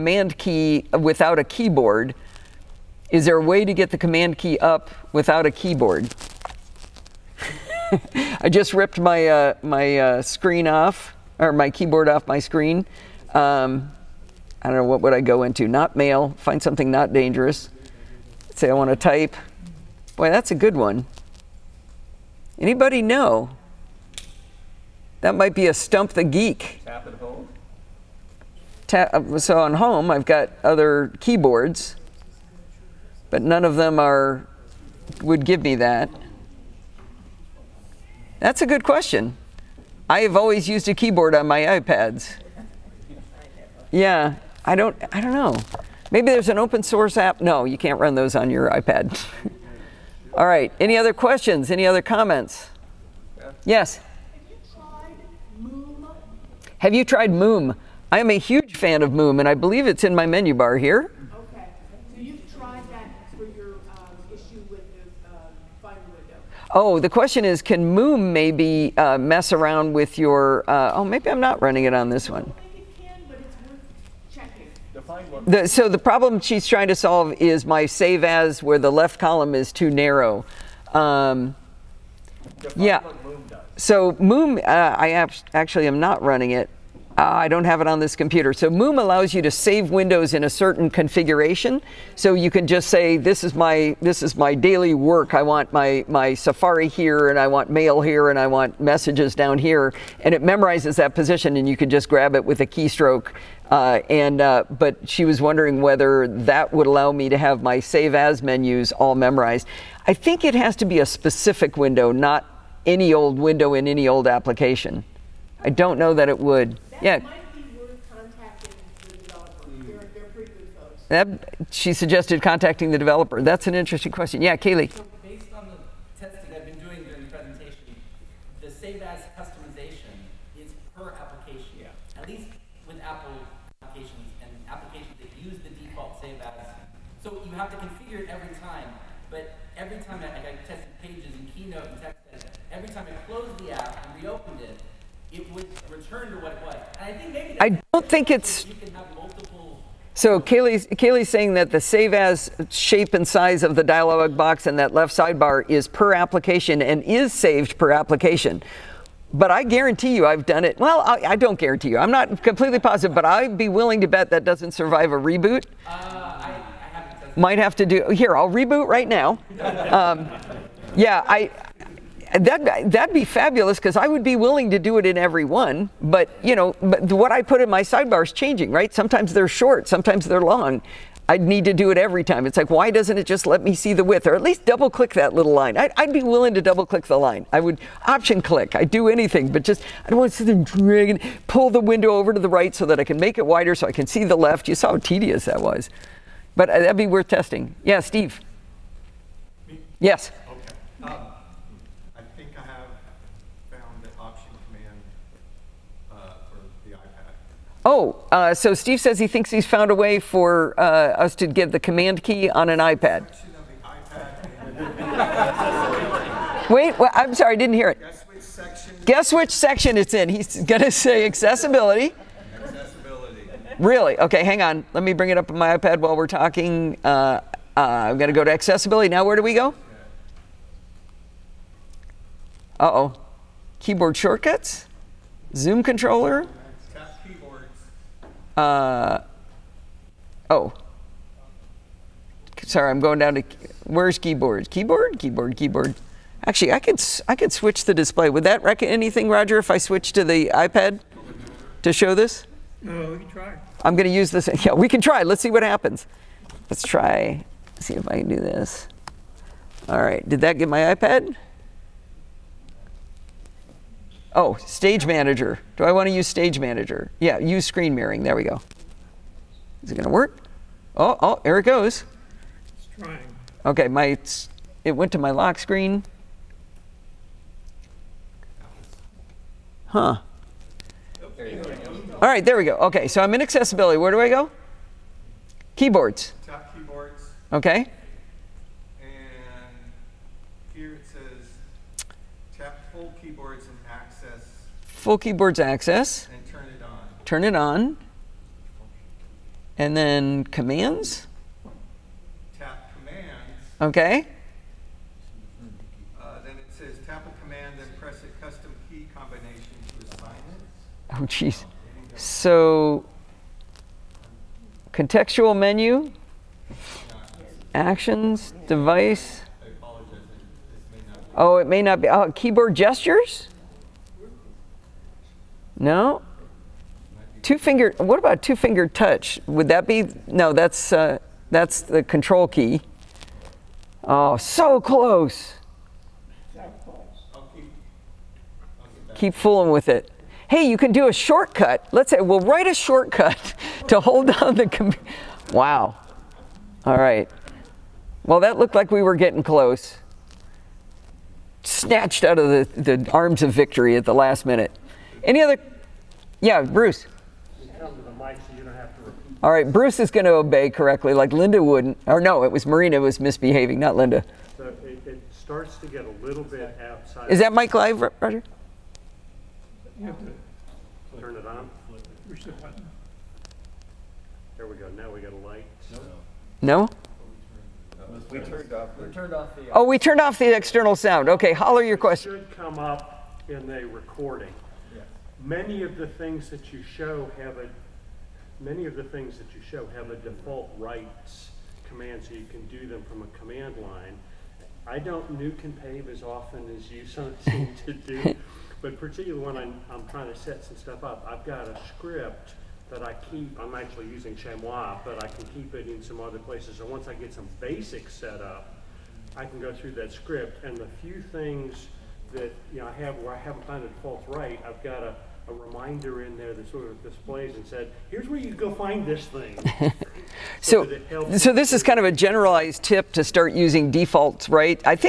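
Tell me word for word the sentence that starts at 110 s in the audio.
I think it has to be a specific window, not any old window in any old application.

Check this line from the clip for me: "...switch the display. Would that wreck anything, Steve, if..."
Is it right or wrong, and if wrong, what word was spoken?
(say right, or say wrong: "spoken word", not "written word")
wrong: "Roger", not "Steve".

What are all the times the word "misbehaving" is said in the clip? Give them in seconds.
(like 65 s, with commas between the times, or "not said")
363 s.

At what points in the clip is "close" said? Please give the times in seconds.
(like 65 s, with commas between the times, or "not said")
334 s, 349 s.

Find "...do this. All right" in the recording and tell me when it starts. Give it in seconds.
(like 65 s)
258 s.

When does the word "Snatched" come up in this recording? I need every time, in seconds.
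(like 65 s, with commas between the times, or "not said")
351 s.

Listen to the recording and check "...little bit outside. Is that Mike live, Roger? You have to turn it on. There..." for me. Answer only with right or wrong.
right.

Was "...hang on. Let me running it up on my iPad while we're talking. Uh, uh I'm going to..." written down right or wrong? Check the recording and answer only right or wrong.
wrong.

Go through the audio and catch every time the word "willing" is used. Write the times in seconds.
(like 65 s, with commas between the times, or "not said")
163 s, 174 s, 186 s.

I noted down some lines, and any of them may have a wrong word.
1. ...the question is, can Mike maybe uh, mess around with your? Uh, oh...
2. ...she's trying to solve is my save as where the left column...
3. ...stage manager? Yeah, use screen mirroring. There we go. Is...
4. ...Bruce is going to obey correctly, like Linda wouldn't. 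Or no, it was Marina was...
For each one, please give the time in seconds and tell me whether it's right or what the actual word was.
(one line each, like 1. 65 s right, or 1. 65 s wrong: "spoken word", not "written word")
1. 66 s wrong: "Moom", not "Mike"
2. 76 s right
3. 266 s right
4. 359 s right.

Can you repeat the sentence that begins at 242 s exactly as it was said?
Sorry, I'm going down to where's keyboard?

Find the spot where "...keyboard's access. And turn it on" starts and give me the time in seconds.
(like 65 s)
295 s.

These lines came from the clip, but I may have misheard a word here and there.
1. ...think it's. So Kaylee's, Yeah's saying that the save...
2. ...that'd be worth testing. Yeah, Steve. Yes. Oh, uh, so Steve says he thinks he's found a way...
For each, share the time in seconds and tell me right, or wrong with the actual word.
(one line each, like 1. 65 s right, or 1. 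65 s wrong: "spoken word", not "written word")
1. 148 s wrong: "Kaylee", not "Yeah"
2. 196 s right.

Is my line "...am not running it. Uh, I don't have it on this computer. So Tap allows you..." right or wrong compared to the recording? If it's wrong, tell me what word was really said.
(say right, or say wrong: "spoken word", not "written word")
wrong: "Moom", not "Tap".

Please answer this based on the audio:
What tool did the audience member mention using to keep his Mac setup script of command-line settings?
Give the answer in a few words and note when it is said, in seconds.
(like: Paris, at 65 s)
chezmoi, at 404 s.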